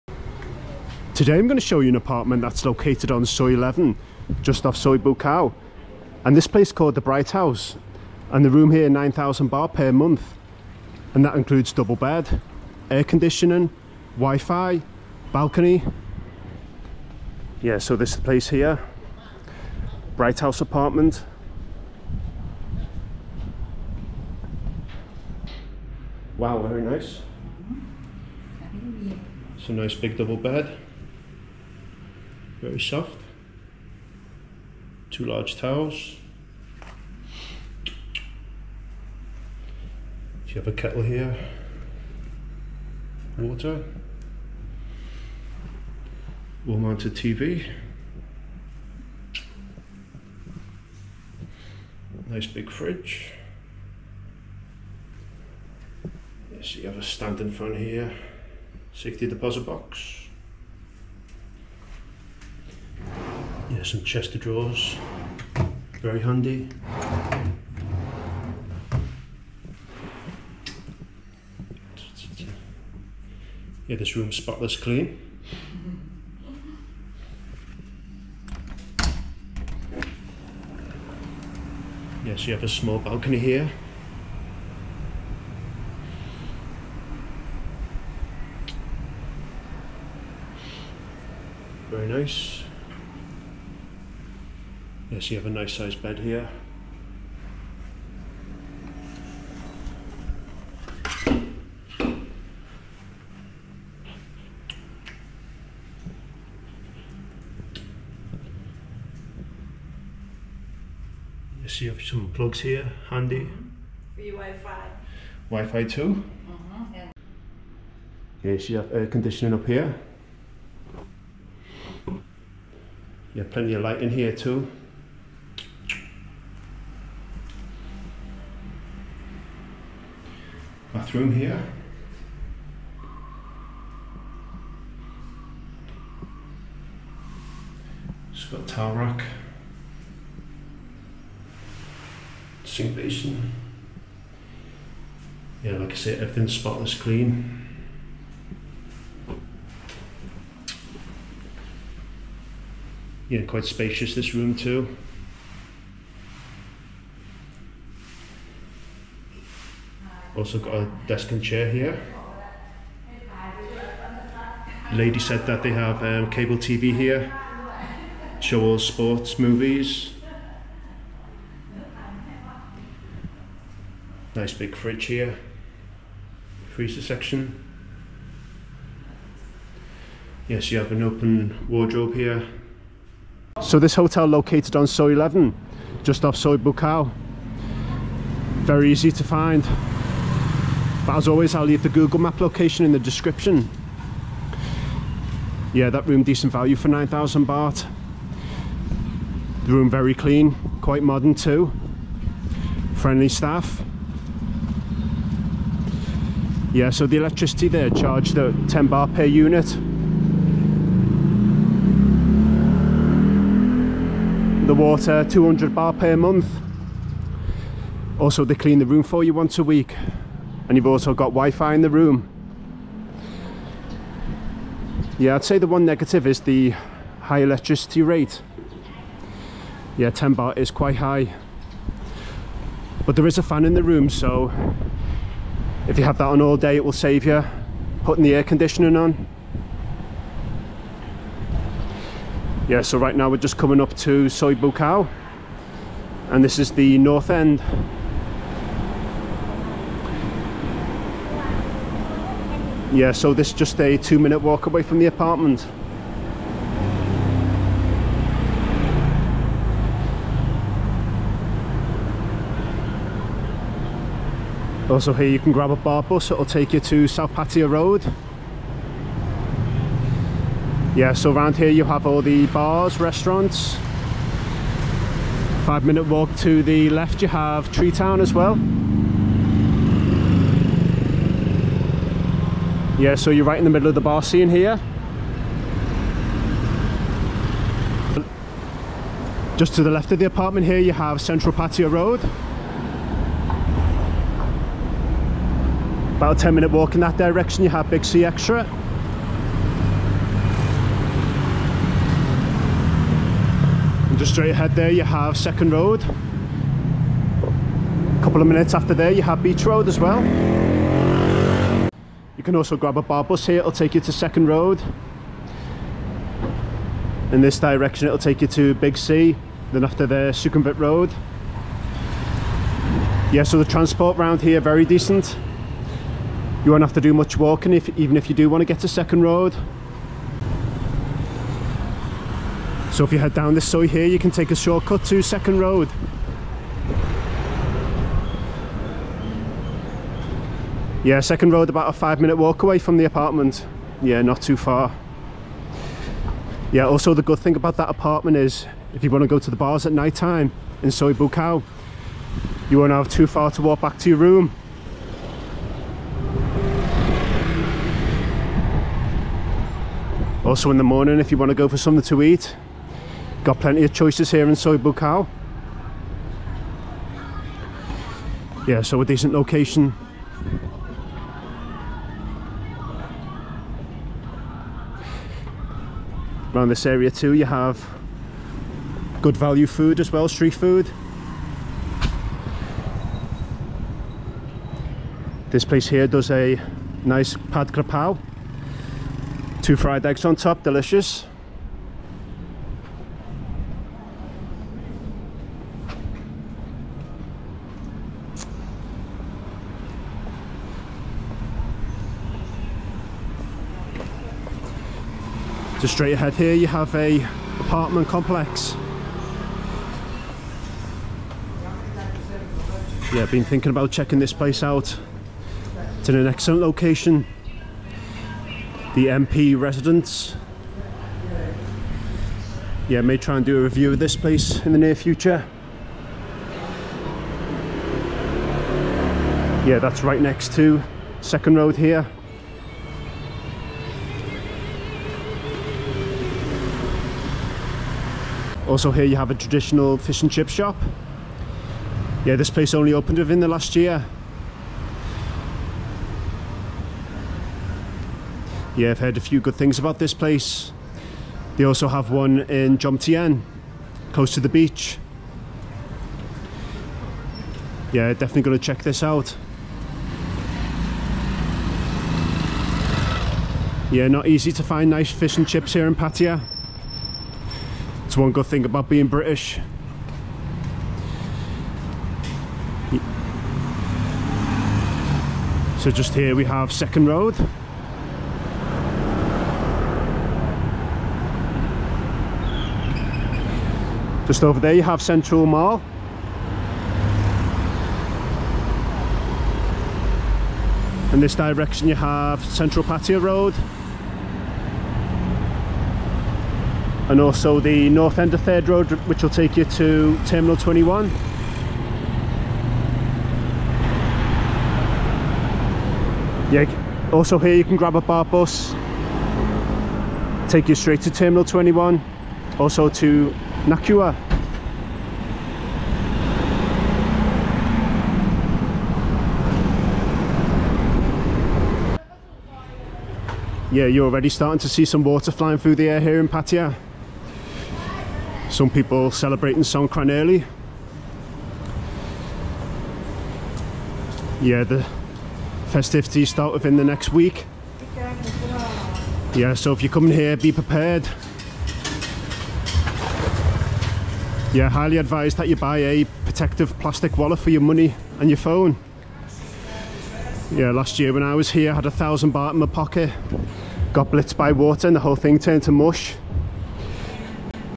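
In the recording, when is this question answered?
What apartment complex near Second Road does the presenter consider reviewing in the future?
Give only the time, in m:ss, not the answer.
6:58.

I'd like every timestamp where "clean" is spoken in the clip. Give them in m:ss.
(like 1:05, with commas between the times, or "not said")
1:14, 2:26, 3:20, 3:38.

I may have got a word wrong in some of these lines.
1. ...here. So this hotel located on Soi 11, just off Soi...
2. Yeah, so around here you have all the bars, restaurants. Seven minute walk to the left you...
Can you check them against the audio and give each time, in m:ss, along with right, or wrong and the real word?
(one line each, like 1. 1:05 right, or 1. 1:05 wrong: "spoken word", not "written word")
1. 3:02 right
2. 4:30 wrong: "Five", not "Seven".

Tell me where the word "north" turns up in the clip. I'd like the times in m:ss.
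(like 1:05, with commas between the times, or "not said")
4:06, 8:17.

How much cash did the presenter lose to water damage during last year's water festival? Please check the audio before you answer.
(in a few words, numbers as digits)
1,000 baht.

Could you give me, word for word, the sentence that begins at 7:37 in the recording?
Yeah, definitely going to check this out.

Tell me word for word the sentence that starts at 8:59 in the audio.
Yeah, so if you're coming here, be prepared.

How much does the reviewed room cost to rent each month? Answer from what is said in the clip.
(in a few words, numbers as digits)
9,000 baht.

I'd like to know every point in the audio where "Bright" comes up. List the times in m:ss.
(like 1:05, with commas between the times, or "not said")
0:07, 0:20.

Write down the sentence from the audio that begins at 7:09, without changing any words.
Yeah, that's right next to Second Road here.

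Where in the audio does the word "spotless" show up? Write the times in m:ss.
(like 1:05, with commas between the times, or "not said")
1:14, 2:26.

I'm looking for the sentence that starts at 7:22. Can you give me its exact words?
Yeah, this place only opened within the last year.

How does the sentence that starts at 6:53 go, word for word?
Yeah, been thinking about checking this place out.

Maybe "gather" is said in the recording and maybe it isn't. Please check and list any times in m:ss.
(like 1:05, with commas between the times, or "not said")
not said.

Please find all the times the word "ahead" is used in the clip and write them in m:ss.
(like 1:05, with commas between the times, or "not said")
5:04, 6:46.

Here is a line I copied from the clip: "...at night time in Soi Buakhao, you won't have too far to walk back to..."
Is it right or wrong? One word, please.
right.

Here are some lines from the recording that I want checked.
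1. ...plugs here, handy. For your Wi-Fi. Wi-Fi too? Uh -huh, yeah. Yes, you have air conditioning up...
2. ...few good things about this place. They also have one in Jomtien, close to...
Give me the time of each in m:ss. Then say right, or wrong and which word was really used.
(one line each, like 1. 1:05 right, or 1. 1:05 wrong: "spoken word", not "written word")
1. 1:52 right
2. 7:29 right.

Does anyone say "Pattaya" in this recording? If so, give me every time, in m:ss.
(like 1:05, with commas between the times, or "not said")
4:27, 4:51, 7:45, 8:12, 8:46.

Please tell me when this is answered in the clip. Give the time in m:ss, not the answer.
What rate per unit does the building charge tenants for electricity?
3:28.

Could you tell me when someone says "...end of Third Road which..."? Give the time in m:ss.
8:18.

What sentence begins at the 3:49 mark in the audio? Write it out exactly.
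Yeah, 10 baht is quite high.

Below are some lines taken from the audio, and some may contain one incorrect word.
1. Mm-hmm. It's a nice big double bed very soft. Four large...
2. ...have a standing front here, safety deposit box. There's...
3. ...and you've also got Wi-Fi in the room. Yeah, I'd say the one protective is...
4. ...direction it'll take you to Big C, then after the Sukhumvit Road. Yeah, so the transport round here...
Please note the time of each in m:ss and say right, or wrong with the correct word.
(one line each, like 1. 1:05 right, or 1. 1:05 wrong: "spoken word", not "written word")
1. 0:28 wrong: "Two", not "Four"
2. 0:56 right
3. 3:40 wrong: "negative", not "protective"
4. 5:17 right.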